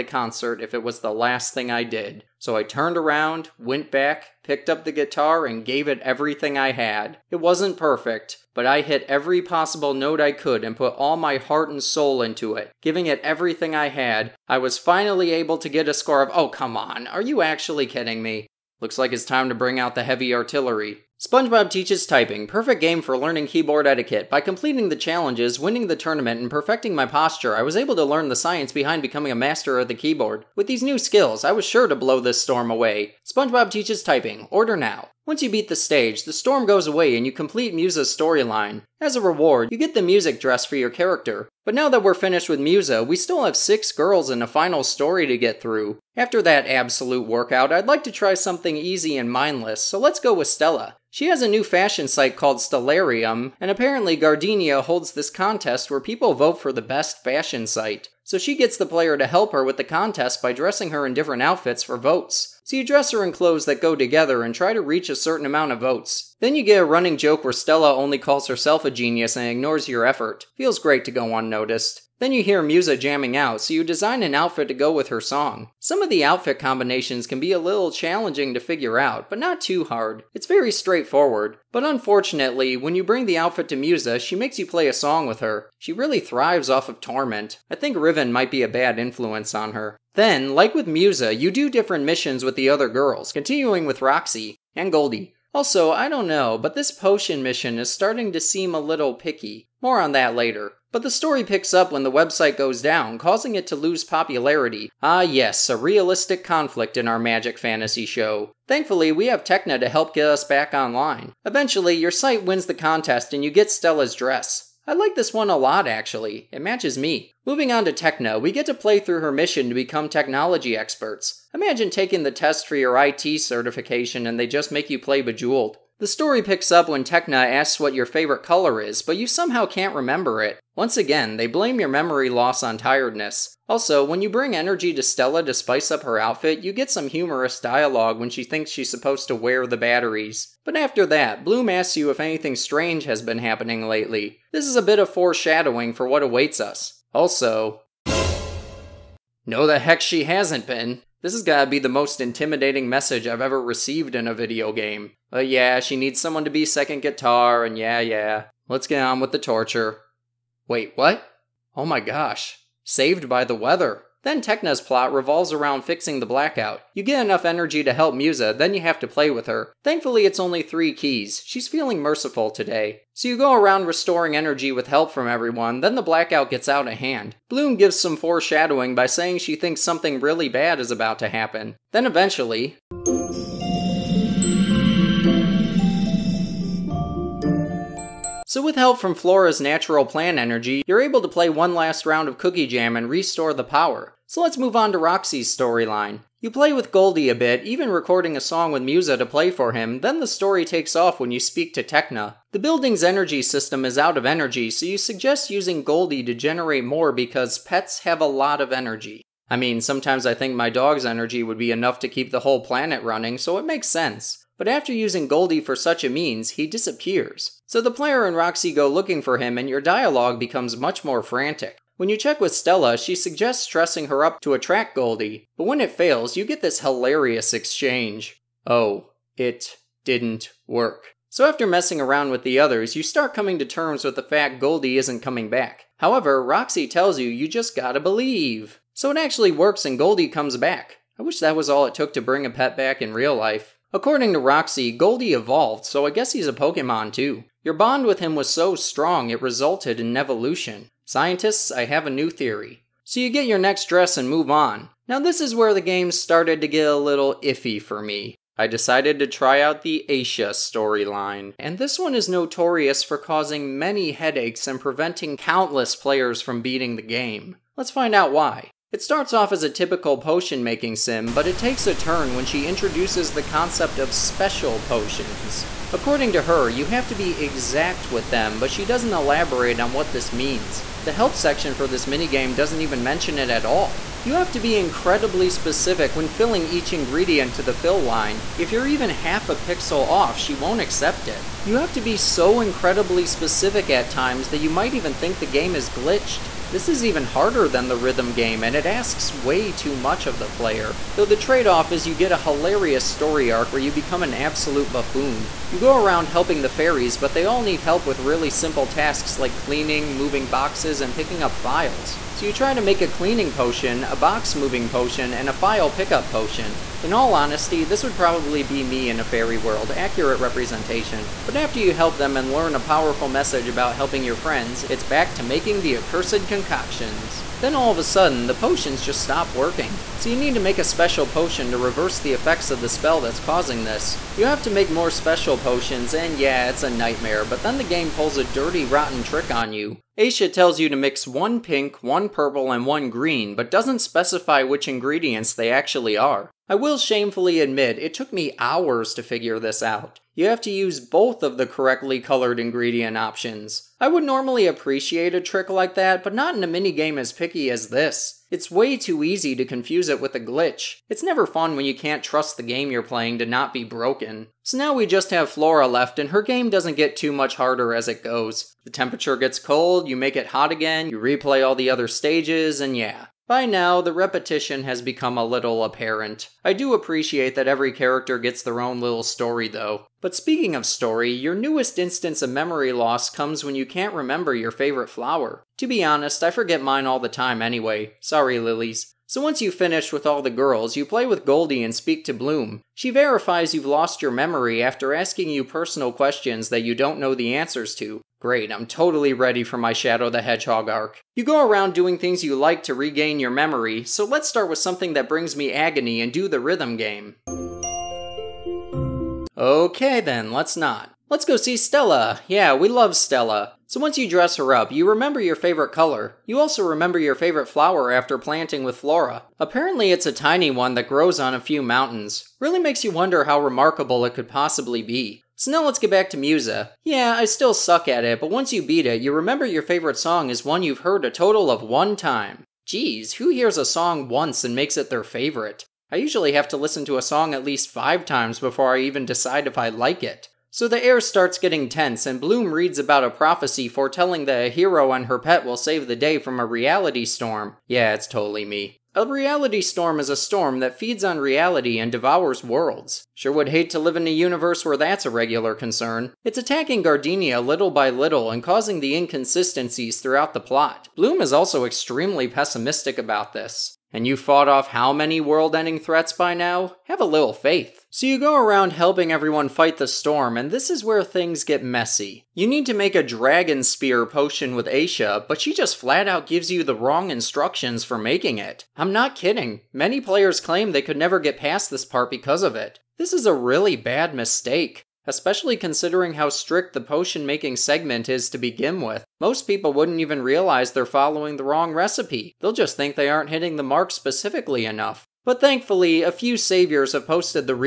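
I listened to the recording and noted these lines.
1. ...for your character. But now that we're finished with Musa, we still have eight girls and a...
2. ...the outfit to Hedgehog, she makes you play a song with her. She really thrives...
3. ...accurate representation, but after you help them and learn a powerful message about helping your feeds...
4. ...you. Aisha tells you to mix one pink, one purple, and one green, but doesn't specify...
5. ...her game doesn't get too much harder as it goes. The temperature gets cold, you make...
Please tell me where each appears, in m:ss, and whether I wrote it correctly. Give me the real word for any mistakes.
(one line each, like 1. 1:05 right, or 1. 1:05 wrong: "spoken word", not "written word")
1. 0:40 wrong: "six", not "eight"
2. 1:23 wrong: "Musa", not "Hedgehog"
3. 5:19 wrong: "friends", not "feeds"
4. 5:39 right
5. 6:06 right.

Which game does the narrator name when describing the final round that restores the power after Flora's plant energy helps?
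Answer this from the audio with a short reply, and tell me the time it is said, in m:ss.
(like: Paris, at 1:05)
Cookie Jam, at 3:12.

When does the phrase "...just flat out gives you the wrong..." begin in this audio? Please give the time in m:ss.
7:55.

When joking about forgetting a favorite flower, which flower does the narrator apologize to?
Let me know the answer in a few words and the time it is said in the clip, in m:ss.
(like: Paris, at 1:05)
lilies, at 6:28.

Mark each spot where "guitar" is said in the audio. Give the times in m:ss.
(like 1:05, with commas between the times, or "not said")
0:04, 2:37.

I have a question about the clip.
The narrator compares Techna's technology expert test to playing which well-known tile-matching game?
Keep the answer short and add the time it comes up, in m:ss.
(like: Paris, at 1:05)
Bejeweled, at 2:05.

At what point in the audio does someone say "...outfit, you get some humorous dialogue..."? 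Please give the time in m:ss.
2:16.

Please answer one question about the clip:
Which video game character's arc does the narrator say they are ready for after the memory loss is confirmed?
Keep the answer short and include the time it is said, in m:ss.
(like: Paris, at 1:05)
Shadow the Hedgehog, at 6:39.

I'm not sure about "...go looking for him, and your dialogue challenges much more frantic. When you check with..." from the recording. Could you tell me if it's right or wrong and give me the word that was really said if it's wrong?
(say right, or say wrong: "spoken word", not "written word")
wrong: "becomes", not "challenges".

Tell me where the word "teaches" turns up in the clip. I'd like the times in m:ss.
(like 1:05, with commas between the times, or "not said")
0:21, 0:33.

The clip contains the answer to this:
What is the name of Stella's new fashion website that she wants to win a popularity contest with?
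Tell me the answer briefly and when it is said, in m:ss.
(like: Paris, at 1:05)
Stellarium, at 0:52.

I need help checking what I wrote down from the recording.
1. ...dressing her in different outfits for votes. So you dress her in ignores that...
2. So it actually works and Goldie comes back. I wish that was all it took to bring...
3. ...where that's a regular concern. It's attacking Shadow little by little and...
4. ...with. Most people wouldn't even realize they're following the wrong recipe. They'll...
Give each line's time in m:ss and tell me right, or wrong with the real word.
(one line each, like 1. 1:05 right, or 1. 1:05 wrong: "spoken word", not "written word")
1. 1:00 wrong: "clothes", not "ignores"
2. 3:58 right
3. 7:34 wrong: "Gardenia", not "Shadow"
4. 8:08 right.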